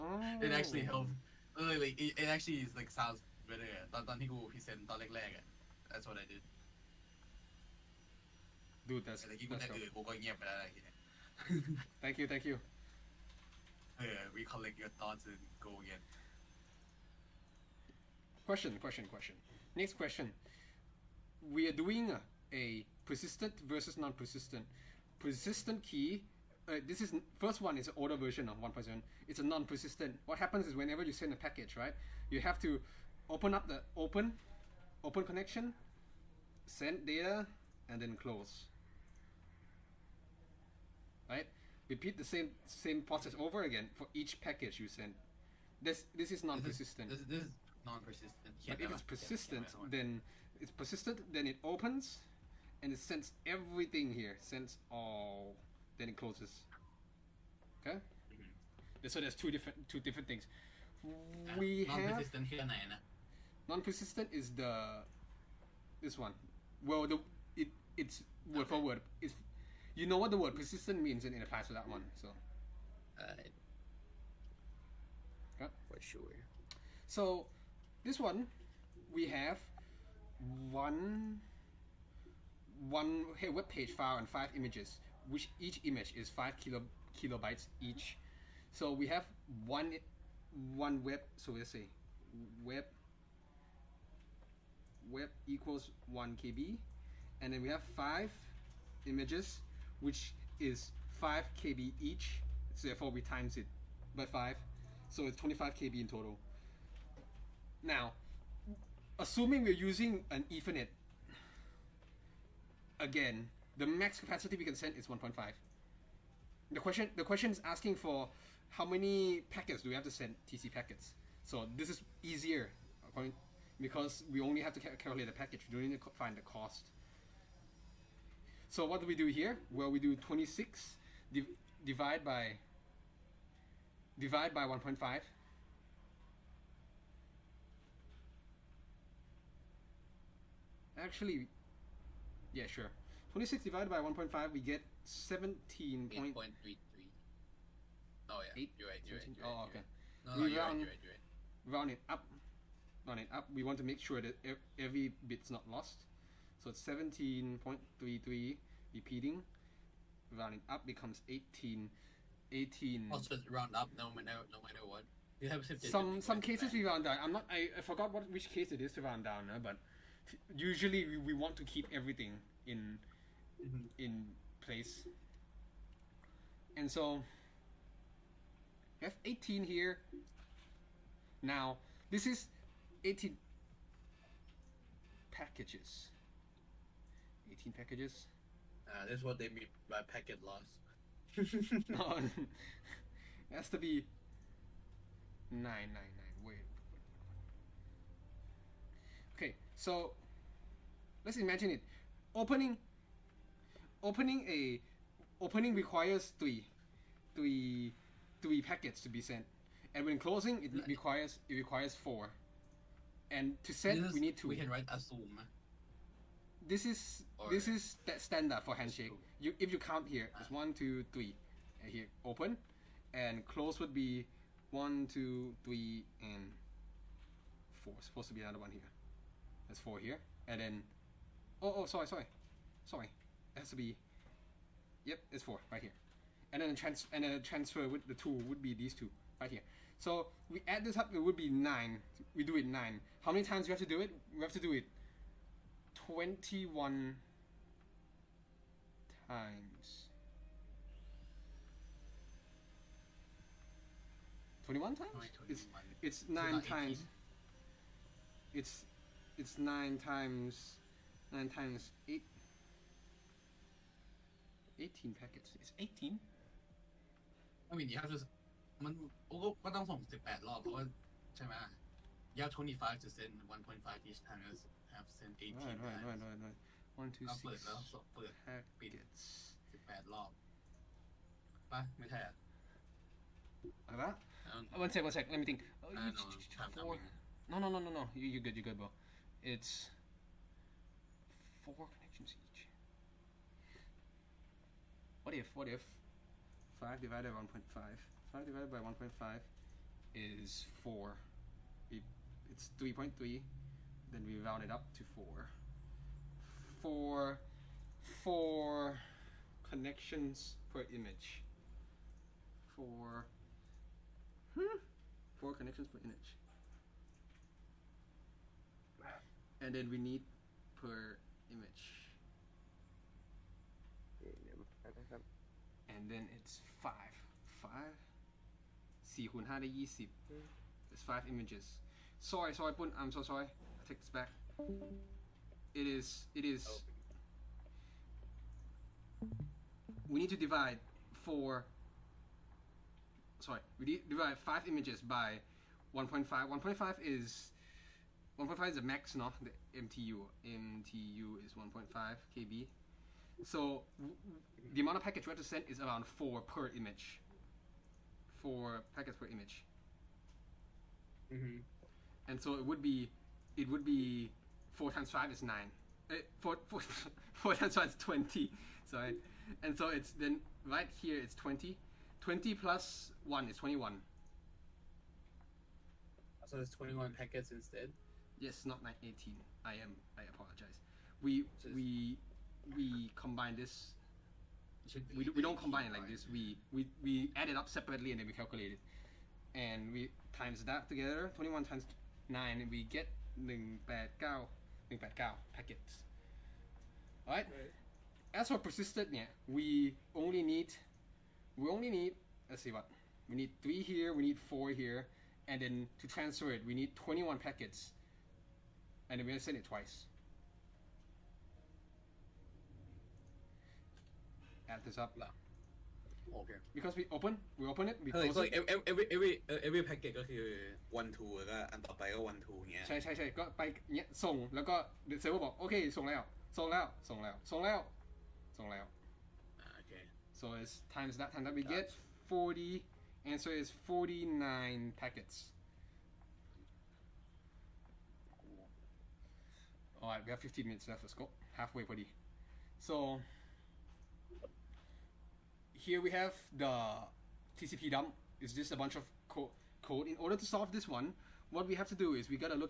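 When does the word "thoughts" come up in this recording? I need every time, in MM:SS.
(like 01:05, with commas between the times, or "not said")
00:14.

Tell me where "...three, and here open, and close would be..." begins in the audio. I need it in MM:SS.
03:41.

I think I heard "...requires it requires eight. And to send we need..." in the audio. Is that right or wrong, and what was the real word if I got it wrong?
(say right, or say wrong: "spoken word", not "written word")
wrong: "four", not "eight".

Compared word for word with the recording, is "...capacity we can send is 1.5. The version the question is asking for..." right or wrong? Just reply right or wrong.
wrong.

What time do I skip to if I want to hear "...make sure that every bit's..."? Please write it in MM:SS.
02:33.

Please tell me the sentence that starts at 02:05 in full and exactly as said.
We don't need to find the cost.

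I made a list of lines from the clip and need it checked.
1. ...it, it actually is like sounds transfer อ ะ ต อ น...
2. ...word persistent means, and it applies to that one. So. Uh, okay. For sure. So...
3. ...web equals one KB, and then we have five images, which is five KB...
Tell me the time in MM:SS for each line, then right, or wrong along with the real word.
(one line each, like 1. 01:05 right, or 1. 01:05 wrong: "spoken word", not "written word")
1. 00:02 wrong: "better", not "transfer"
2. 01:10 right
3. 01:35 right.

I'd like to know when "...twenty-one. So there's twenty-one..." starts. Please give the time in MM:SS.
06:13.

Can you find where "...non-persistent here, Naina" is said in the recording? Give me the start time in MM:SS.
01:02.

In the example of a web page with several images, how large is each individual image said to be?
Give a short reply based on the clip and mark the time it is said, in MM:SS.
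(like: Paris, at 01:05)
5 KB, at 01:26.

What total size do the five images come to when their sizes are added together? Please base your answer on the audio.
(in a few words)
25 KB.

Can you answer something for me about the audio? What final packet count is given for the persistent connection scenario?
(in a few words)
49.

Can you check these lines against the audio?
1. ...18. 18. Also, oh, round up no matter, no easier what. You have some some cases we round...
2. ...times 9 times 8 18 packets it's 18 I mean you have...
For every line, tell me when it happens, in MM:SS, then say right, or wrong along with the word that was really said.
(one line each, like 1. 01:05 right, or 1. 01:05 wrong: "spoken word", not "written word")
1. 02:41 wrong: "matter", not "easier"
2. 04:20 right.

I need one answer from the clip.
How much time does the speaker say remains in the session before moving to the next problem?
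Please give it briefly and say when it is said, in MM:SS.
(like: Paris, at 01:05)
15 minutes, at 07:20.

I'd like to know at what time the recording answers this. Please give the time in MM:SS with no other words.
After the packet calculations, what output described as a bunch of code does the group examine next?
07:27.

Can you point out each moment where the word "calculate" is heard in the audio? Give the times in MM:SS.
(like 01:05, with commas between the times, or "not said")
02:04, 06:28.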